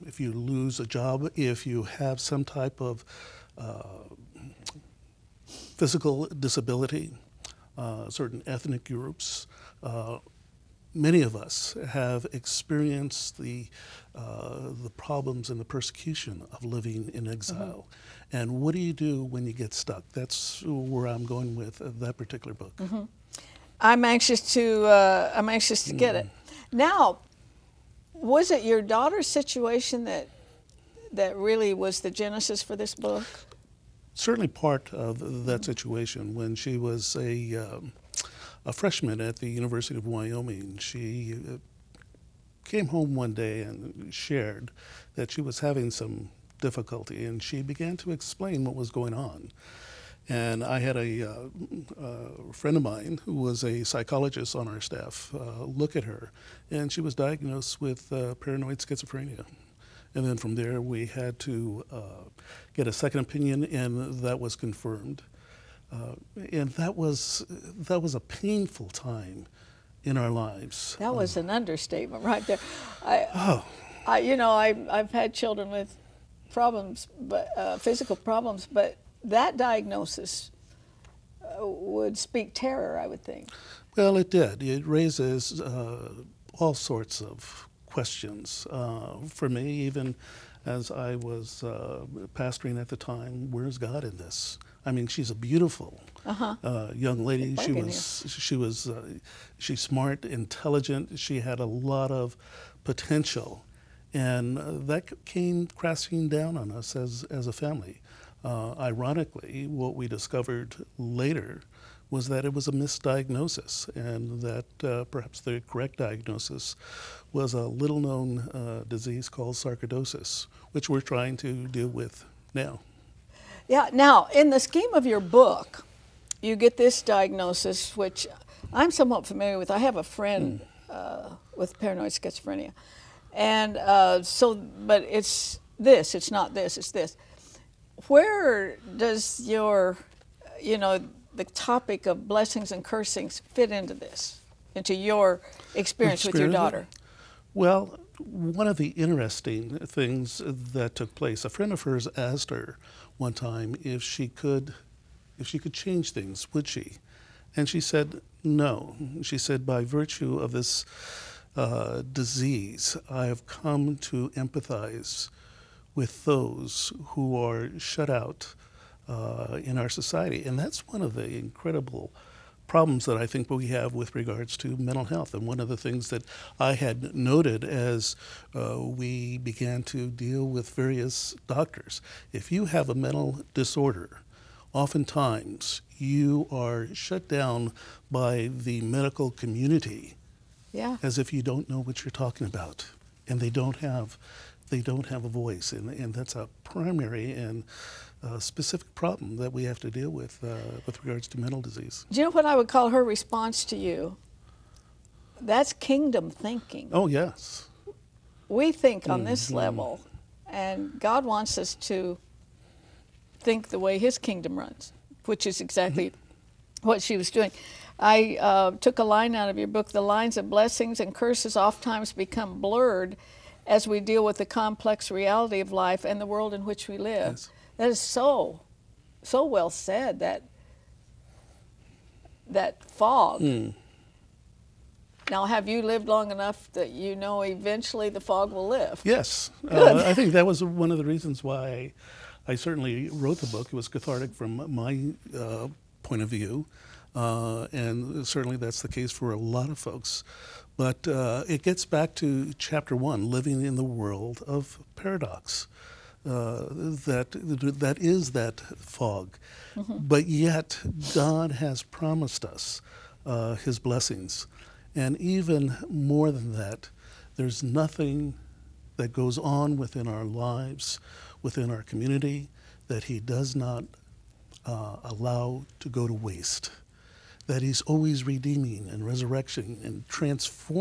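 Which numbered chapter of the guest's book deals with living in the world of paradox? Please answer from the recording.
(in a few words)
chapter one.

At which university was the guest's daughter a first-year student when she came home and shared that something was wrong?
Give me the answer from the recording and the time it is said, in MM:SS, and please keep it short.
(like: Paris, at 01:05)
University of Wyoming, at 00:39.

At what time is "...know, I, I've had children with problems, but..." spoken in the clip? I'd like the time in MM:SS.
01:14.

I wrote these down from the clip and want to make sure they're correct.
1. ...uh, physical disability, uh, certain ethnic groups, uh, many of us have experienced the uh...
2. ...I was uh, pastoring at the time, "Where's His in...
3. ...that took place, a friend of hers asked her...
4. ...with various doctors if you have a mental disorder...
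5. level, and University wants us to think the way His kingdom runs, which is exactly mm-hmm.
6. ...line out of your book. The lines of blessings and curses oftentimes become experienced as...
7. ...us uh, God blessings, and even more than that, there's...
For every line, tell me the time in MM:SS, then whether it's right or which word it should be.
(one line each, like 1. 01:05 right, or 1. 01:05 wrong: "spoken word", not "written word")
1. 00:03 right
2. 01:30 wrong: "God", not "His"
3. 02:30 right
4. 03:00 right
5. 03:29 wrong: "God", not "University"
6. 03:39 wrong: "blurred", not "experienced"
7. 04:22 wrong: "His", not "God".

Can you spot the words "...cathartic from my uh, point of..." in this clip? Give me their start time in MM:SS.
04:03.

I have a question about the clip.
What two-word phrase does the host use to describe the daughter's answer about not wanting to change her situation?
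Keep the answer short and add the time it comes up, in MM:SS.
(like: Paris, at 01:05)
kingdom thinking, at 03:25.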